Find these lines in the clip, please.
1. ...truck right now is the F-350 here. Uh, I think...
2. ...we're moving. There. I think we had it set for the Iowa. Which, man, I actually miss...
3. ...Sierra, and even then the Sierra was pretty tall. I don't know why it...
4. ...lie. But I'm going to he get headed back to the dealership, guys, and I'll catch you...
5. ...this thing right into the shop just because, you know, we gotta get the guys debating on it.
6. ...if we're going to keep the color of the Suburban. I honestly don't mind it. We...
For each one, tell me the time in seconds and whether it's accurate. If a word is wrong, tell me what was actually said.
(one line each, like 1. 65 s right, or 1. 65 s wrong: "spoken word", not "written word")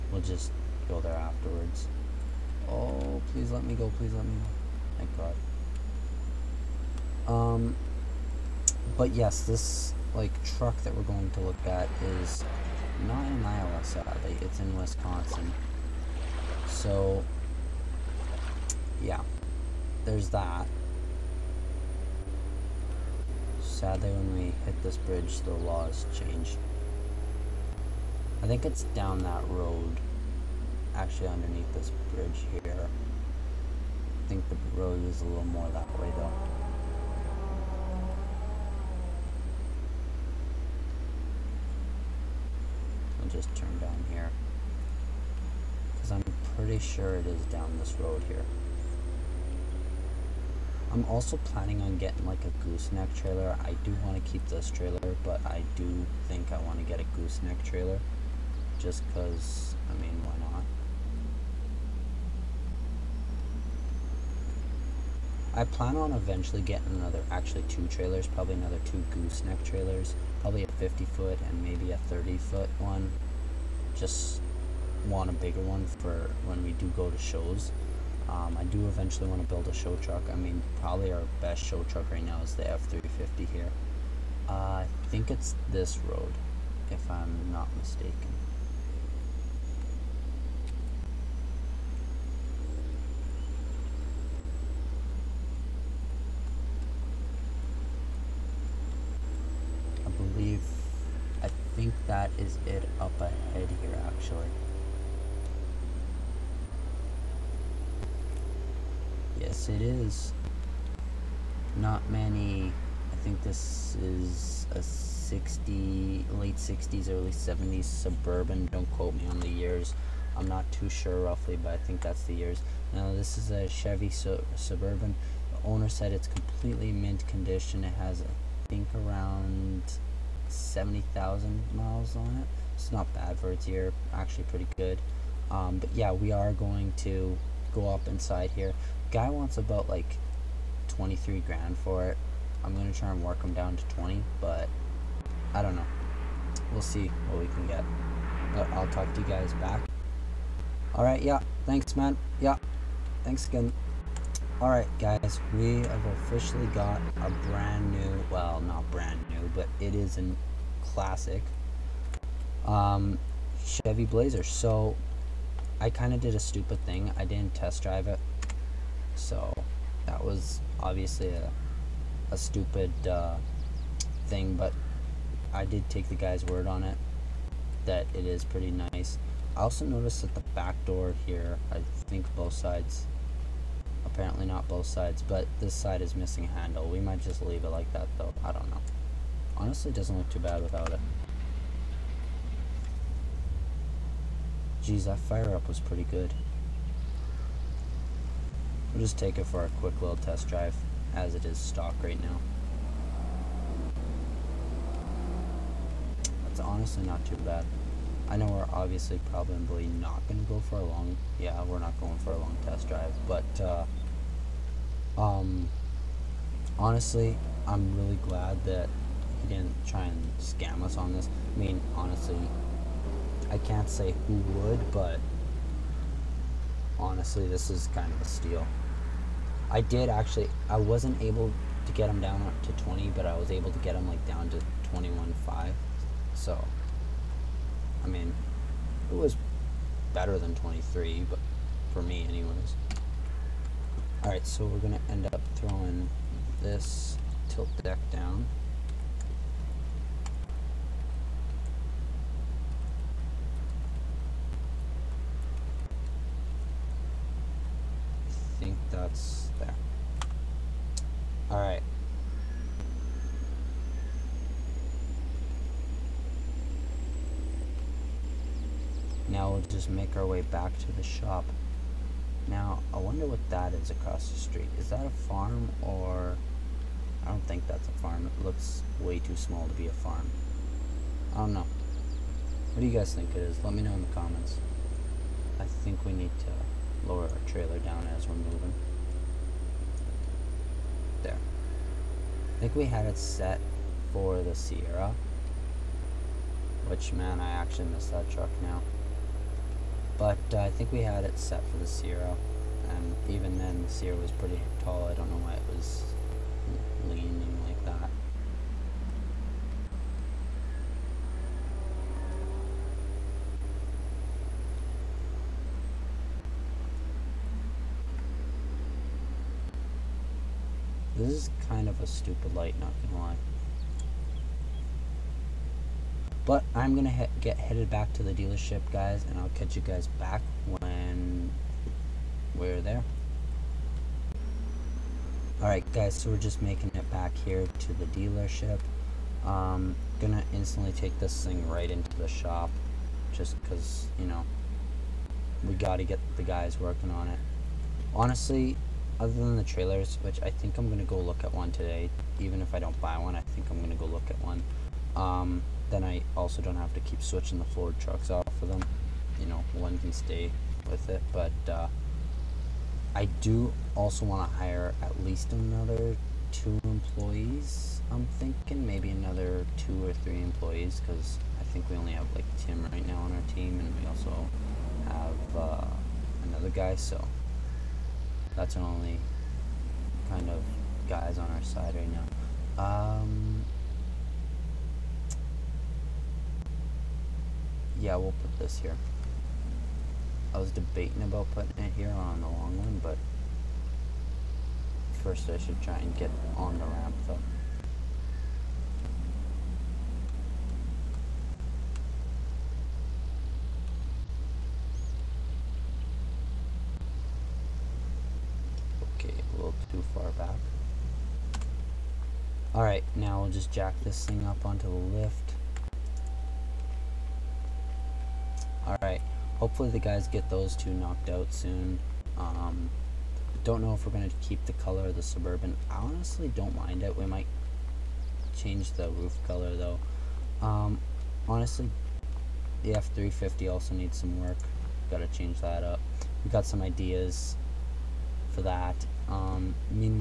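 1. 81 s right
2. 288 s wrong: "Sierra", not "Iowa"
3. 301 s right
4. 323 s right
5. 341 s wrong: "working", not "debating"
6. 423 s right.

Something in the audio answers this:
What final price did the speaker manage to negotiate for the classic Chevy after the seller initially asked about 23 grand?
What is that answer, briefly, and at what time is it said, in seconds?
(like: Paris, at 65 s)
21.5, at 234 s.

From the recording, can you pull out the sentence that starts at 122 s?
Now, this is a Chevy su- Suburban.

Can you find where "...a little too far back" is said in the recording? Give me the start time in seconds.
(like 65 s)
409 s.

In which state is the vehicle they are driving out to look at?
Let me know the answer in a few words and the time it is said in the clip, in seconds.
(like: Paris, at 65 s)
Wisconsin, at 14 s.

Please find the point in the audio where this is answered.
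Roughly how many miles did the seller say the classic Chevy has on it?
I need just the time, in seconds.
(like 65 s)
130 s.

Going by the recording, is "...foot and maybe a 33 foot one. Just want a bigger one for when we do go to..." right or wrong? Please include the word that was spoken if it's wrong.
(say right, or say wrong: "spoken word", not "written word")
wrong: "30", not "33".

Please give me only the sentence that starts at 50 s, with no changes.
I'm also planning on getting like a gooseneck trailer.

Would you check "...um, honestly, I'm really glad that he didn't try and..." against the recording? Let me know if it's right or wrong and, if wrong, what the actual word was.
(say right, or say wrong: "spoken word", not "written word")
right.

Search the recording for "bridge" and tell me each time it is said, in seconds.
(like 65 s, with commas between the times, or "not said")
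24 s, 32 s.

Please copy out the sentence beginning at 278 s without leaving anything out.
It looks way too small to be a farm.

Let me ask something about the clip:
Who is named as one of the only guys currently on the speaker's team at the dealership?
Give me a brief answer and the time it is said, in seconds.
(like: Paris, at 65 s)
Tim, at 372 s.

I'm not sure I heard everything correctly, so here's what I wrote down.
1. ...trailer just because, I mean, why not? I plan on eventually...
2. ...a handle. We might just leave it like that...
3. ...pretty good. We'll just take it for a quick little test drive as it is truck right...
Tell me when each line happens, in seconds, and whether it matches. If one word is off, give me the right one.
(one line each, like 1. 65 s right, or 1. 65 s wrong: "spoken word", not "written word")
1. 57 s right
2. 186 s right
3. 195 s wrong: "stock", not "truck".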